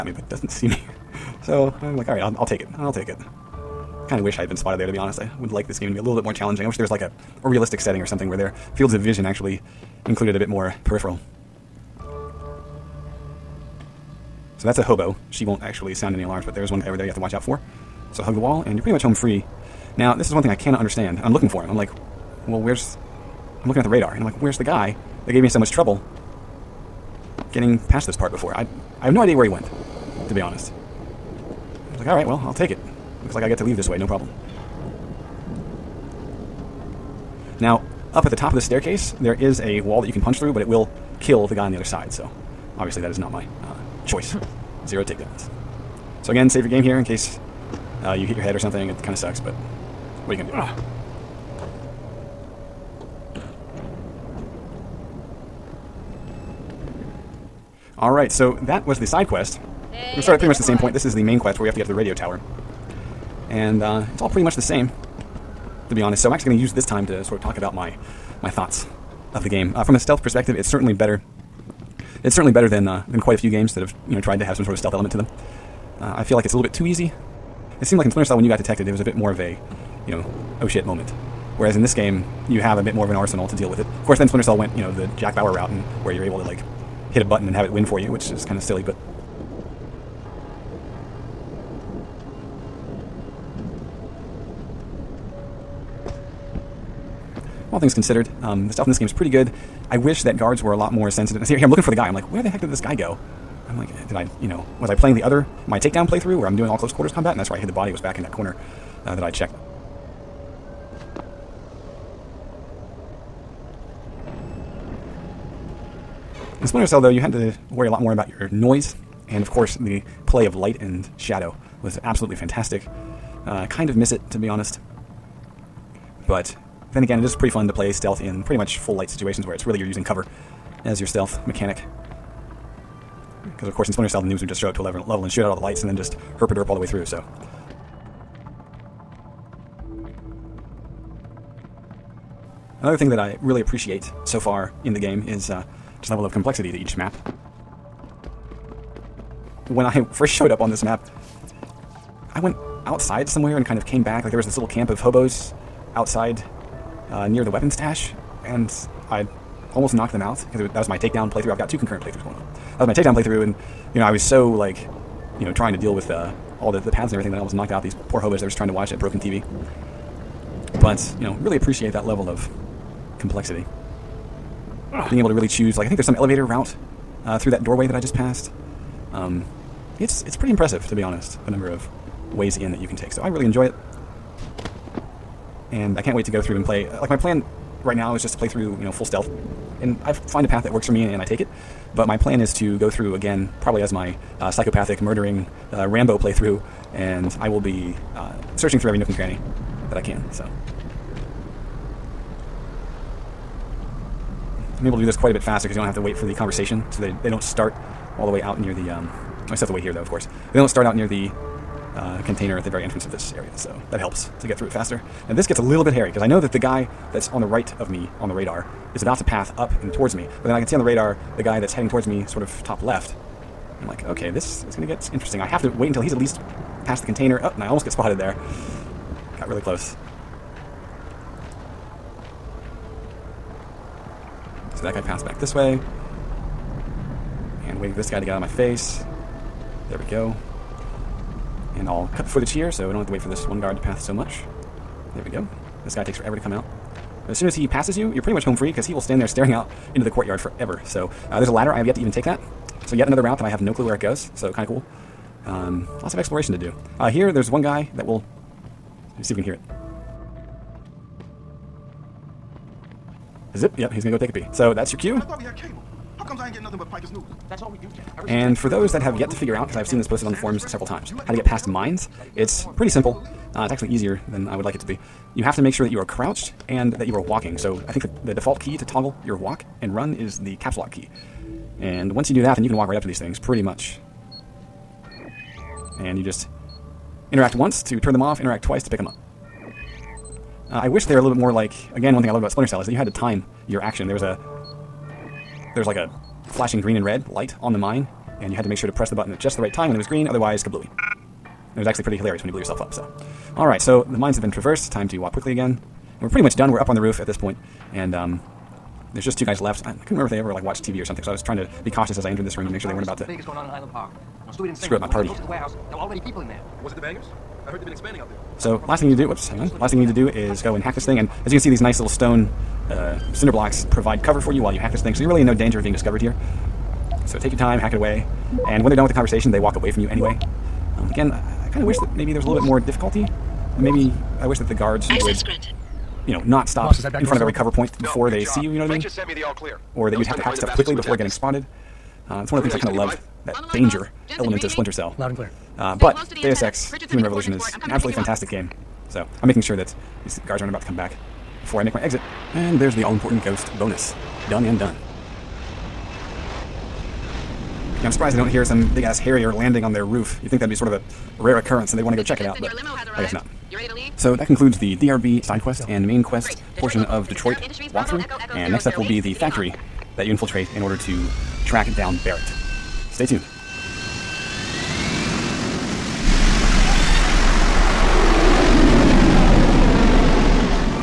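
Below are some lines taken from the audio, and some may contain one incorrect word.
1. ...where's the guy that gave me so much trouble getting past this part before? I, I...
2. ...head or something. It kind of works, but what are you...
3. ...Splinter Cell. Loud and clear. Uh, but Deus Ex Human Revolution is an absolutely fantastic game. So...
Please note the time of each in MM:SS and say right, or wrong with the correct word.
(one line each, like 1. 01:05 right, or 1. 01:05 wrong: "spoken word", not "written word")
1. 00:24 right
2. 00:48 wrong: "sucks", not "works"
3. 05:44 right.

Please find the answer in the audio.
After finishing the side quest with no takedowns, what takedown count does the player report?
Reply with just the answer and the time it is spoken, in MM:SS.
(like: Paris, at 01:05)
0, at 00:44.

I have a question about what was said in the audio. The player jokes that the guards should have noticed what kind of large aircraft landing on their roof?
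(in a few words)
Harrier.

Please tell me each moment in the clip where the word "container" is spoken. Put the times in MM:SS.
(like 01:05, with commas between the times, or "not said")
03:32, 03:47.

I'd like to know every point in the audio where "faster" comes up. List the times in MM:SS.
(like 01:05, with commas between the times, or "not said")
03:25, 03:34.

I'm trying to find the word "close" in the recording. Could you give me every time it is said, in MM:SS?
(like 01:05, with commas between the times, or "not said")
01:46, 03:49, 05:15.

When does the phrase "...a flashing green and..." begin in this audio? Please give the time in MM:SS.
04:55.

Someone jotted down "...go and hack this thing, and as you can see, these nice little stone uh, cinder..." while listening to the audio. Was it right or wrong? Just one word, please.
right.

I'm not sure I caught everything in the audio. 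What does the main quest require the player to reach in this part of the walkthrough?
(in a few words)
The radio tower.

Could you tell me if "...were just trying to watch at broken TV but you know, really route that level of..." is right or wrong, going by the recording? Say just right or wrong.
wrong.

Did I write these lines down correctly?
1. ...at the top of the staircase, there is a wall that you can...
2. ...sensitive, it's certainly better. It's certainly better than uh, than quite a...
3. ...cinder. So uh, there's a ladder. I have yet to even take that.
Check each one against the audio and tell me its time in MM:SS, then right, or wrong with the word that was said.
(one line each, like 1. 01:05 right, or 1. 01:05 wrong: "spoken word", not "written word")
1. 00:38 right
2. 01:10 wrong: "perspective", not "sensitive"
3. 04:10 wrong: "forever", not "cinder".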